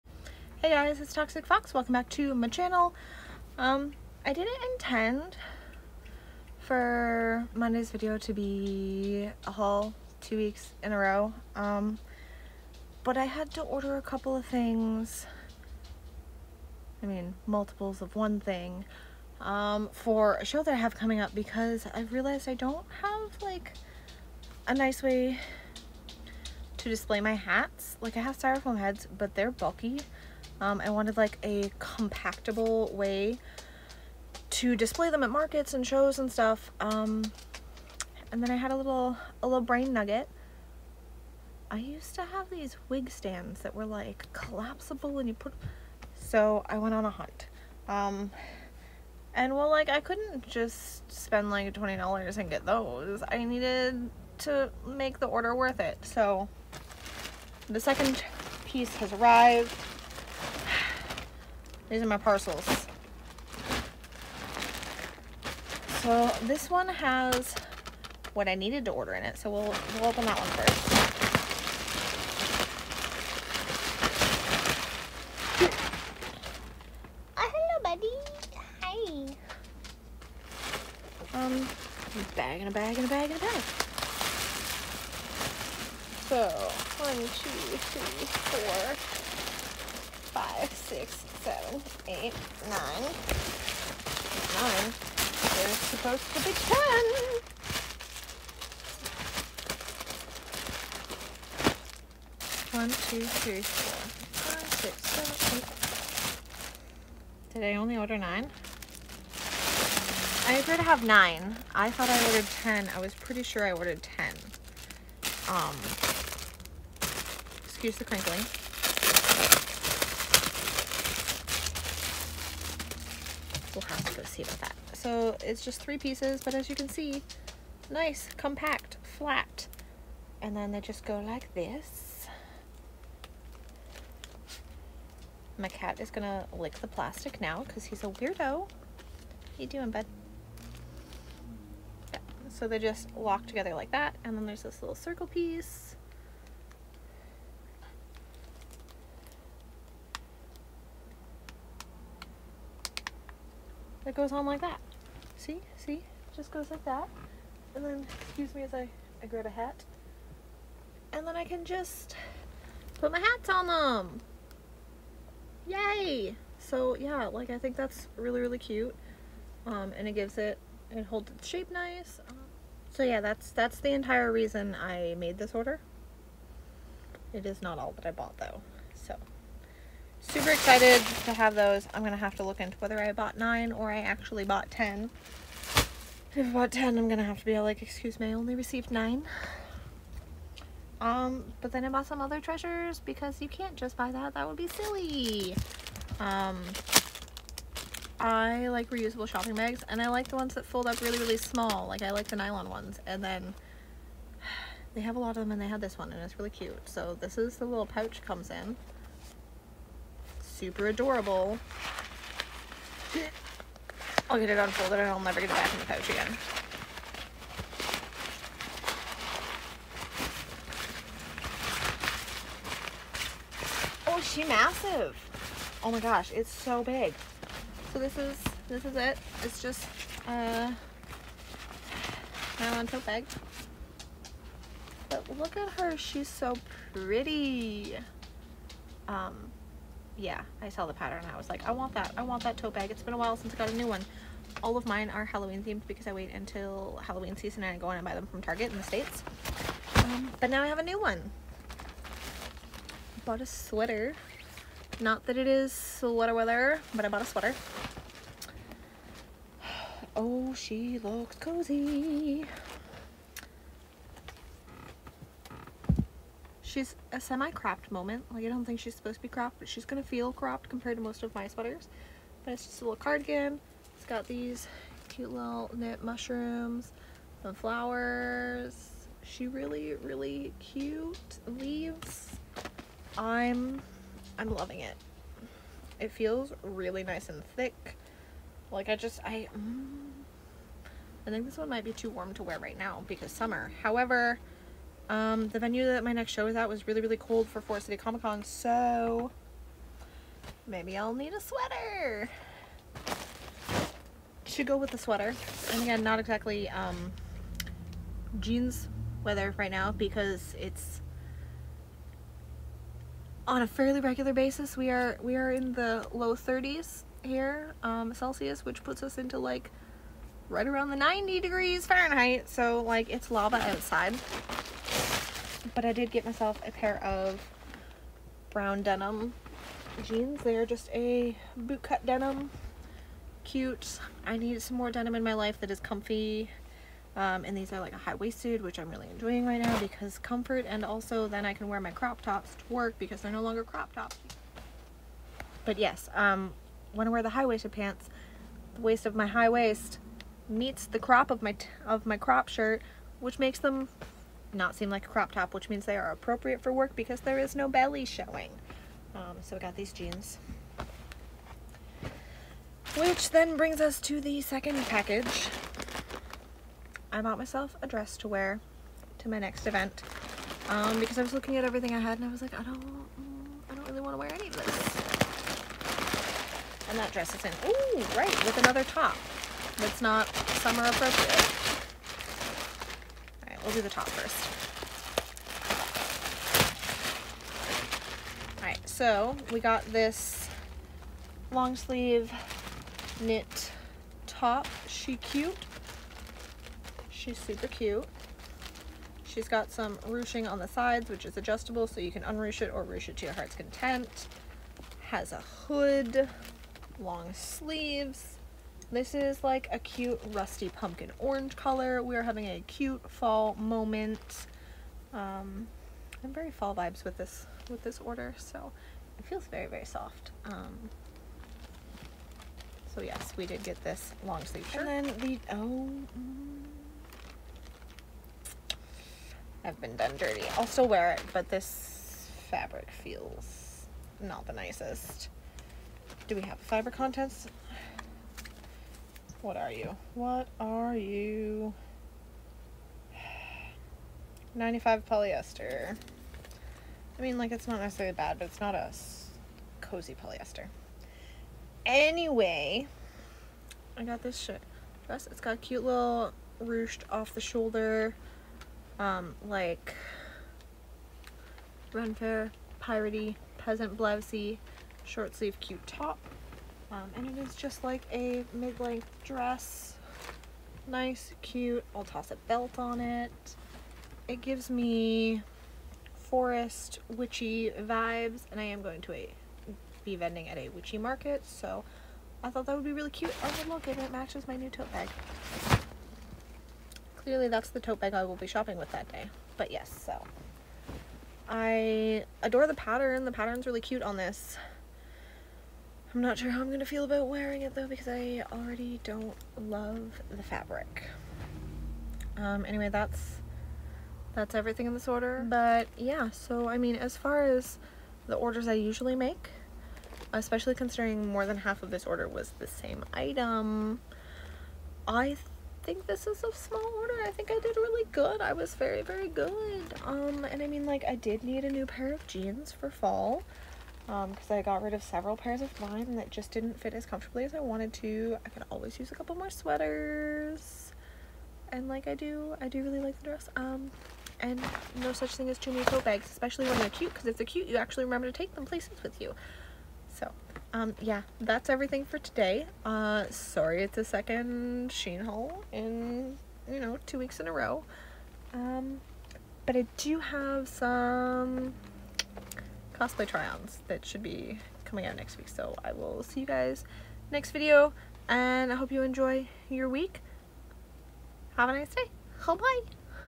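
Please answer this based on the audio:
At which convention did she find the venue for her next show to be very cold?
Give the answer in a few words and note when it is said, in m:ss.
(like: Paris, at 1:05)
Forest City Comic Con, at 4:57.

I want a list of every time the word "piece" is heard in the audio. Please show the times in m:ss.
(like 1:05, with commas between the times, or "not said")
0:58, 2:05, 2:25.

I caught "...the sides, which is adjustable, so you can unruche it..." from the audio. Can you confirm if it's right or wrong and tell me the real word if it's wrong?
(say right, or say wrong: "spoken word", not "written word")
right.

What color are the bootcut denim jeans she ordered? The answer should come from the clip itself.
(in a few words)
brown.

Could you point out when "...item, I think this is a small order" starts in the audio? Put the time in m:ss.
8:33.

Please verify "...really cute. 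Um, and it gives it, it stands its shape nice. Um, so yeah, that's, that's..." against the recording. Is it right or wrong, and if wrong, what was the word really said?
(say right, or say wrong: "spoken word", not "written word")
wrong: "holds", not "stands".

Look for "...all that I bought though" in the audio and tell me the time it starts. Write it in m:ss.
2:57.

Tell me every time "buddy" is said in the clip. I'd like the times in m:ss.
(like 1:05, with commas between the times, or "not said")
1:17.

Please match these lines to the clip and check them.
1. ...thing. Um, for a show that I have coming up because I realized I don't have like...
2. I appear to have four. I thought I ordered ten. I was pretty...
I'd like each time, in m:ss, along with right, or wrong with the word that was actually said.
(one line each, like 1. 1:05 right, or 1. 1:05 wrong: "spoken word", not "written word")
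1. 0:18 right
2. 1:50 wrong: "nine", not "four".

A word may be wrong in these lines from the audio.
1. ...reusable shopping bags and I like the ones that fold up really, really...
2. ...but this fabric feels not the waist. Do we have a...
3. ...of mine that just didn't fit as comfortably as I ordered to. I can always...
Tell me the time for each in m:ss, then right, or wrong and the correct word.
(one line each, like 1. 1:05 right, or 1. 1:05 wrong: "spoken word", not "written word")
1. 3:18 right
2. 7:11 wrong: "nicest", not "waist"
3. 8:45 wrong: "wanted", not "ordered".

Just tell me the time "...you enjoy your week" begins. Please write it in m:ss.
9:18.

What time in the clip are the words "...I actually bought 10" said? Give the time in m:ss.
3:03.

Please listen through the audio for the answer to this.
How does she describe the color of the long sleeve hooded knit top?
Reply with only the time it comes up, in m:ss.
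6:50.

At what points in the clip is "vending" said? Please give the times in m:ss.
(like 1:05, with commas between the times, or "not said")
8:00.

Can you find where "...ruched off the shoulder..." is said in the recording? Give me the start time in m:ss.
7:36.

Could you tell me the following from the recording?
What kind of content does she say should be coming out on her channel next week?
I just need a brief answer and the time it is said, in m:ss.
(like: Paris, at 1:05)
cosplay try-ons, at 9:13.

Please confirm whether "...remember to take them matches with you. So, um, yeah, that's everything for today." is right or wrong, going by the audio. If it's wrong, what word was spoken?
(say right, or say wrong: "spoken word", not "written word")
wrong: "places", not "matches".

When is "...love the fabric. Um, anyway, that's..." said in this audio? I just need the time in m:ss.
8:19.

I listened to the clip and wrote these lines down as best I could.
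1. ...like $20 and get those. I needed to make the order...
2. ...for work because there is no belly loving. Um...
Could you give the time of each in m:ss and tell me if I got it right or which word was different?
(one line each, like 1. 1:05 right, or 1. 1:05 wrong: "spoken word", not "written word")
1. 0:51 right
2. 5:56 wrong: "showing", not "loving".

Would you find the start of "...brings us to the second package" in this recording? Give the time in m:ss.
6:03.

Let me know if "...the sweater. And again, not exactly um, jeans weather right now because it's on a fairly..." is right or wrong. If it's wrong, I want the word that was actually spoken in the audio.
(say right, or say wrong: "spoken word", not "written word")
right.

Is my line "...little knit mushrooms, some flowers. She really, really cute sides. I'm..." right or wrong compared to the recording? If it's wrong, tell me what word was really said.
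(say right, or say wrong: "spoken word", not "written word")
wrong: "leaves", not "sides".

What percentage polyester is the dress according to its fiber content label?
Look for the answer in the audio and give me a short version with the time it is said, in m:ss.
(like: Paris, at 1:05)
95, at 7:24.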